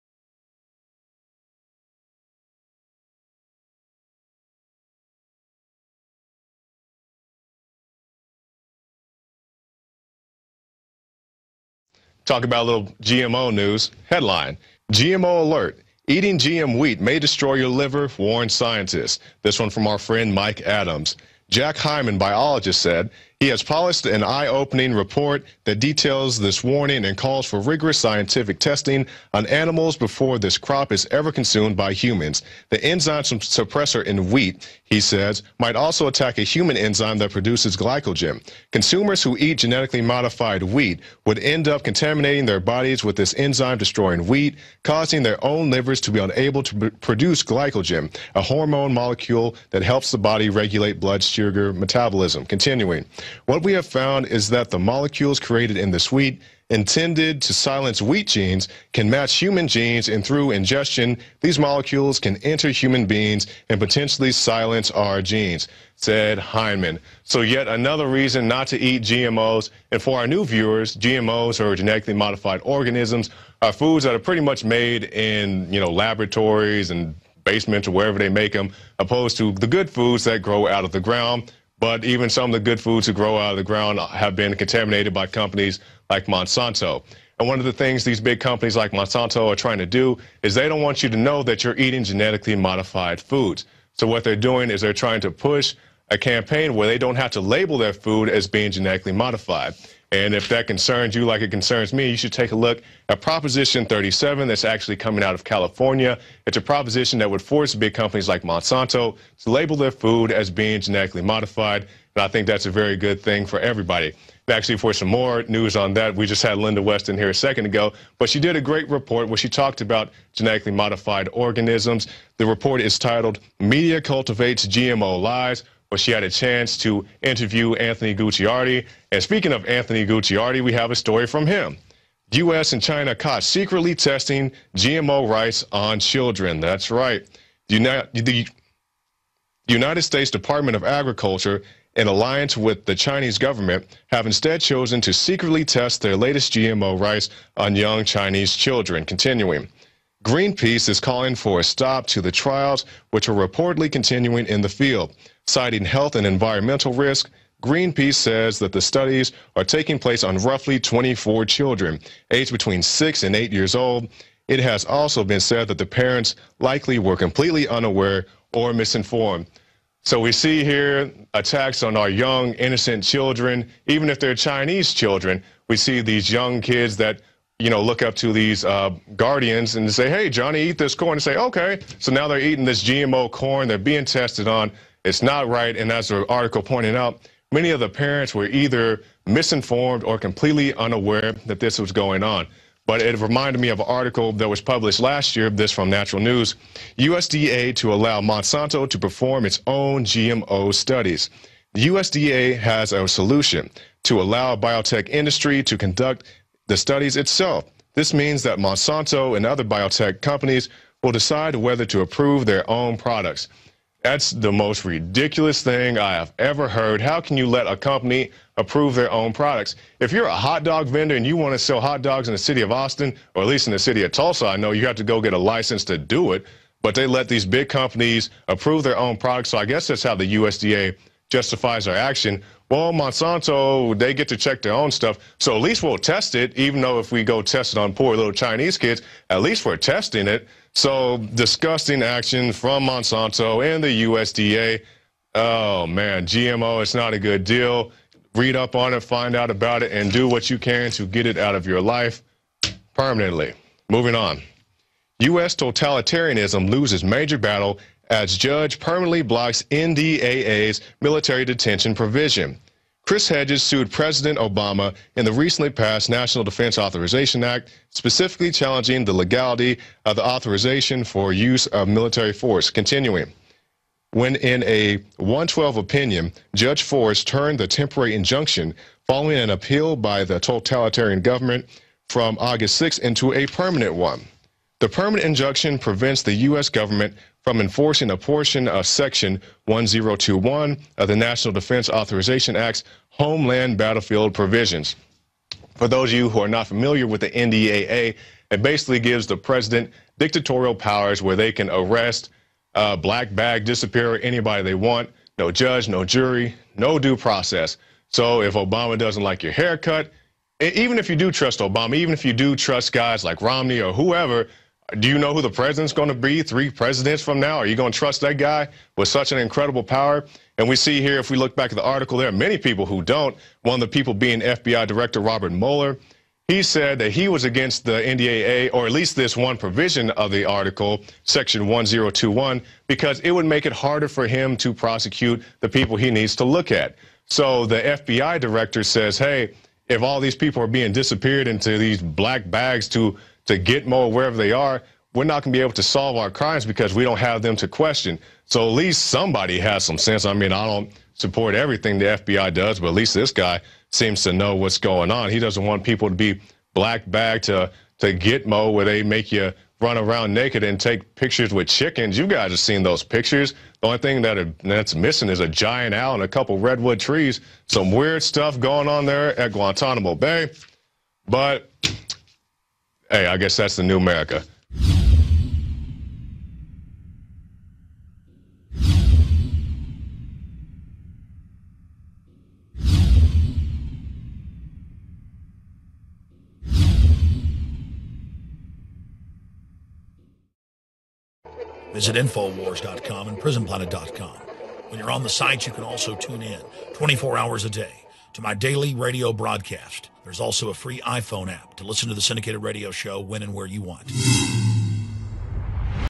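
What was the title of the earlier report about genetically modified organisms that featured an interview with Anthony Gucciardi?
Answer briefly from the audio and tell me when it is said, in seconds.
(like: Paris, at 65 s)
Media Cultivates GMO Lies, at 123 s.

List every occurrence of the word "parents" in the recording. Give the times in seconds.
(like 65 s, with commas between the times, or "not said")
165 s, 187 s.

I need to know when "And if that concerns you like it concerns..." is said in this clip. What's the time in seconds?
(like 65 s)
100 s.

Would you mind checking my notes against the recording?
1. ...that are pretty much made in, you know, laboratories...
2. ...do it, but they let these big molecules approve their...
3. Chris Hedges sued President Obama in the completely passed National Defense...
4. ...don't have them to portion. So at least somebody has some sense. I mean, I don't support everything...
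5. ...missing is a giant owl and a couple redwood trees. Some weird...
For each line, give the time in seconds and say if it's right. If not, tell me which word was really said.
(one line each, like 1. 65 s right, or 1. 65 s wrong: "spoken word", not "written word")
1. 74 s right
2. 225 s wrong: "companies", not "molecules"
3. 263 s wrong: "recently", not "completely"
4. 347 s wrong: "question", not "portion"
5. 364 s right.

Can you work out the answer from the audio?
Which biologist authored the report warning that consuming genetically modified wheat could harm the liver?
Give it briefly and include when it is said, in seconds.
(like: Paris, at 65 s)
Jack Heinemann, at 21 s.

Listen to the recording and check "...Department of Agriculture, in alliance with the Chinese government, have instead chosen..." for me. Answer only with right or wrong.
right.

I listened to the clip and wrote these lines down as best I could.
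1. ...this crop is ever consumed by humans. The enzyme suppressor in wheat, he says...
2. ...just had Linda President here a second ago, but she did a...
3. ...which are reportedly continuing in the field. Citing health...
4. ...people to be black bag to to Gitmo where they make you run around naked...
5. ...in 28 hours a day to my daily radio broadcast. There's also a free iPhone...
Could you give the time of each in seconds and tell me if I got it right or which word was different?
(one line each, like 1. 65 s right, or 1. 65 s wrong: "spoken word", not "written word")
1. 30 s right
2. 116 s wrong: "Weston", not "President"
3. 153 s right
4. 355 s right
5. 396 s wrong: "24", not "28".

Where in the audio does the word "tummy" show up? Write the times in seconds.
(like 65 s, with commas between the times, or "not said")
not said.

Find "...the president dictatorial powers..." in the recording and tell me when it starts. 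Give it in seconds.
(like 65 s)
299 s.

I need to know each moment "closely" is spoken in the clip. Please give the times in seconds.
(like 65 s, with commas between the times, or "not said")
not said.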